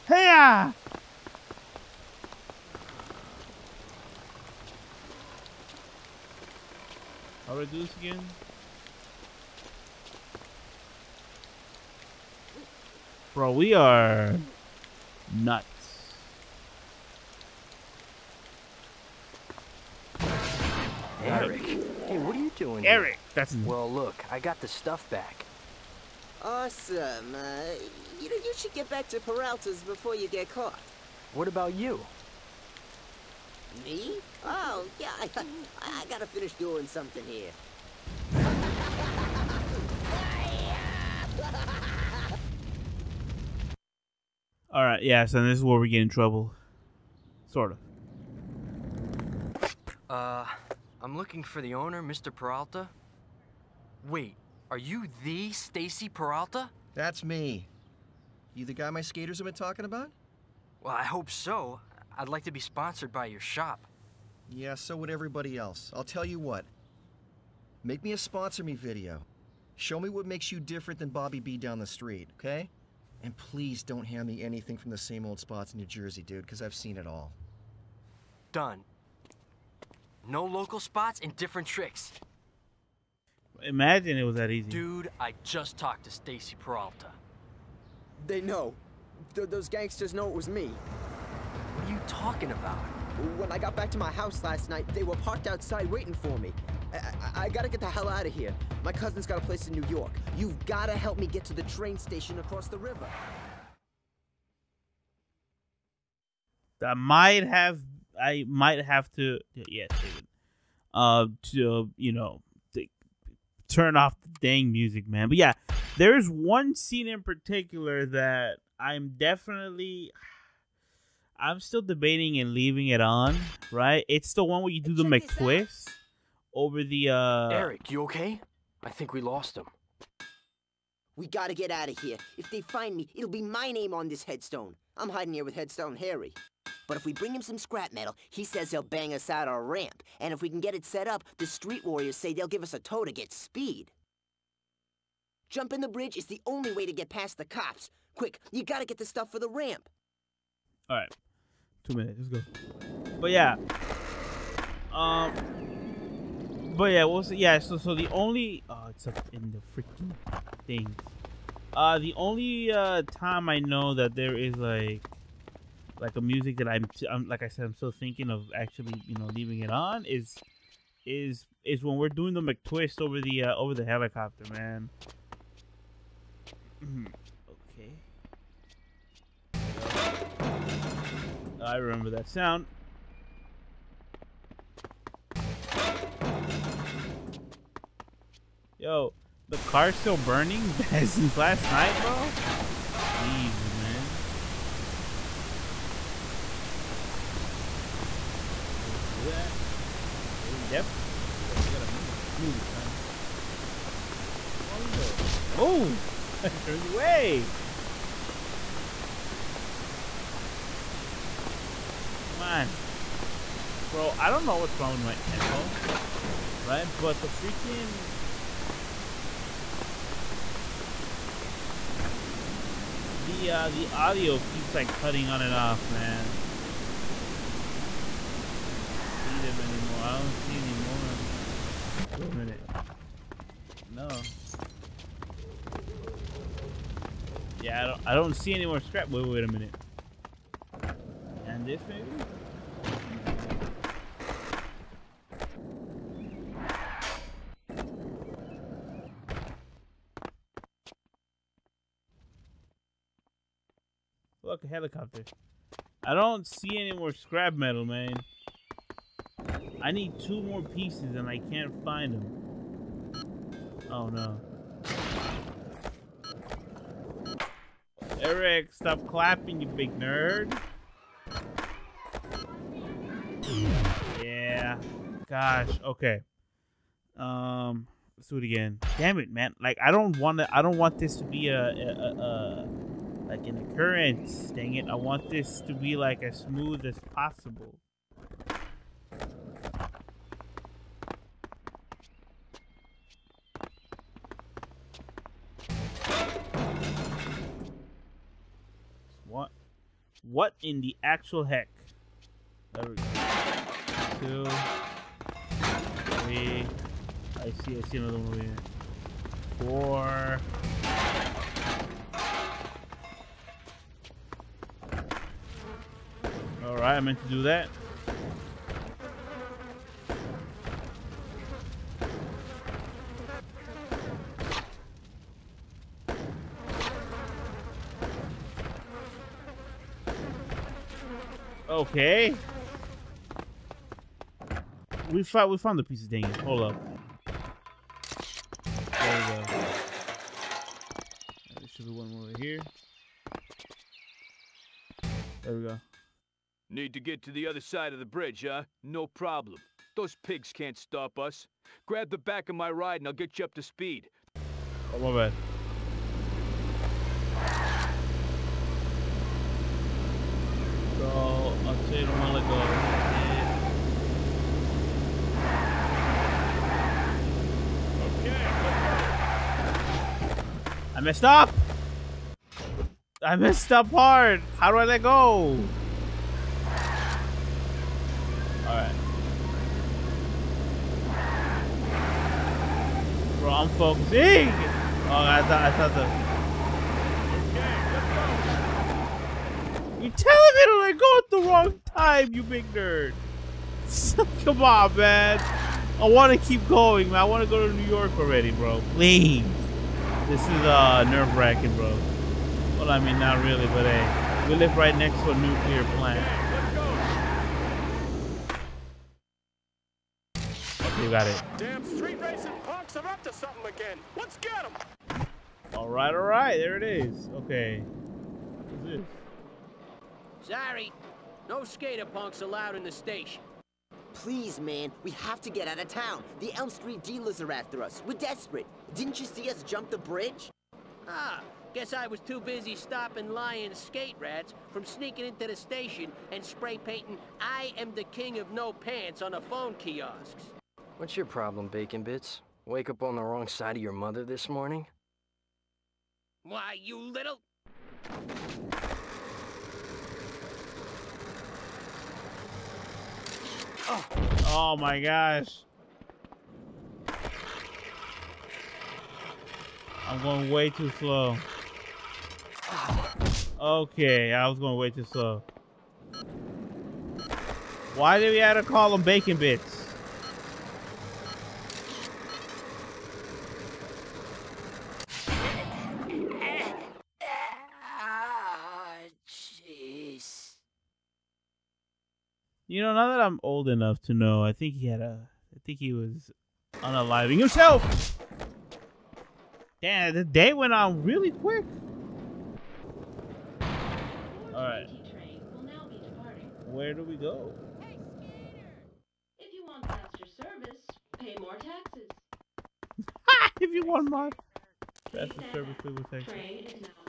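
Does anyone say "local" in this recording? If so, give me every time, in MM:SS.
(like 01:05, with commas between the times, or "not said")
01:20.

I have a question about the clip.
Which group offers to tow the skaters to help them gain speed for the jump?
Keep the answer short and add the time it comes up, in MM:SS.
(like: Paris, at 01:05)
street warriors, at 02:21.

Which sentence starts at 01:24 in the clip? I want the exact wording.
Dude, I just talked to Stacy Peralta.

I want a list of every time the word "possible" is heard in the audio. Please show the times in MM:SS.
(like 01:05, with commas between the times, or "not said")
04:47.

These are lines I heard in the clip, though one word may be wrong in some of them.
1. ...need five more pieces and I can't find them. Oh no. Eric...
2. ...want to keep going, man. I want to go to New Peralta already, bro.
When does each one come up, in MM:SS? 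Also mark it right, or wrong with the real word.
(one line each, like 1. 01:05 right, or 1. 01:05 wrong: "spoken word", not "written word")
1. 04:19 wrong: "two", not "five"
2. 06:36 wrong: "York", not "Peralta".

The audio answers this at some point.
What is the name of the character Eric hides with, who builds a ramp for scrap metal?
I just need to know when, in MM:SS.
02:15.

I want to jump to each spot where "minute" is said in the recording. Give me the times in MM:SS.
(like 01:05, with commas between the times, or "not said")
02:31, 03:52, 03:59.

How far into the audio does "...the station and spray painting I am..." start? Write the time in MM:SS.
07:15.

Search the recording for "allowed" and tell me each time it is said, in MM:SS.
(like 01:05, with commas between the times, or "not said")
07:02.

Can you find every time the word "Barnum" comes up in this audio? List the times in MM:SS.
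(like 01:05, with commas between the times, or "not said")
not said.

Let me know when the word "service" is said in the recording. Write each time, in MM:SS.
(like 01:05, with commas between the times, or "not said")
08:20, 08:25.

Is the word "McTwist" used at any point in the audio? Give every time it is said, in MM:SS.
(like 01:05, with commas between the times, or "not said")
02:05, 02:52.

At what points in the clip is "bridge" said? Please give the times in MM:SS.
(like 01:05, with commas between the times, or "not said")
02:25, 05:48, 07:09.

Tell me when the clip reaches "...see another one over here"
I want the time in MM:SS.
05:07.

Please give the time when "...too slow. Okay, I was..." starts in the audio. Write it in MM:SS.
07:40.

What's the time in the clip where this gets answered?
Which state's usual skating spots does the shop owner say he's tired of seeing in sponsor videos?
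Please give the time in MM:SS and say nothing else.
01:15.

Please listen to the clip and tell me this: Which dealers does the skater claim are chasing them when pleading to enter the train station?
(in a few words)
Elm Street dealers.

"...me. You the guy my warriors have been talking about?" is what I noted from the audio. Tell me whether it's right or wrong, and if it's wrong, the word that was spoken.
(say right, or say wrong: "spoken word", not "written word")
wrong: "skaters", not "warriors".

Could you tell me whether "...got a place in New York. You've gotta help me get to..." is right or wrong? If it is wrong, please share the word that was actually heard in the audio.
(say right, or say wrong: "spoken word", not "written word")
right.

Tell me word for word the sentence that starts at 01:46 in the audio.
That might have I might have to yeah, David, uh, to you know, to turn off the dang music, man.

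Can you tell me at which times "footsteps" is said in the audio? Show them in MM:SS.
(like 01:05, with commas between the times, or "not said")
not said.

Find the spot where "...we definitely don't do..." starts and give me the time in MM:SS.
03:20.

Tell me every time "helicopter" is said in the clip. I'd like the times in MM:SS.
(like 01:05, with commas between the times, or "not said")
02:53, 04:14.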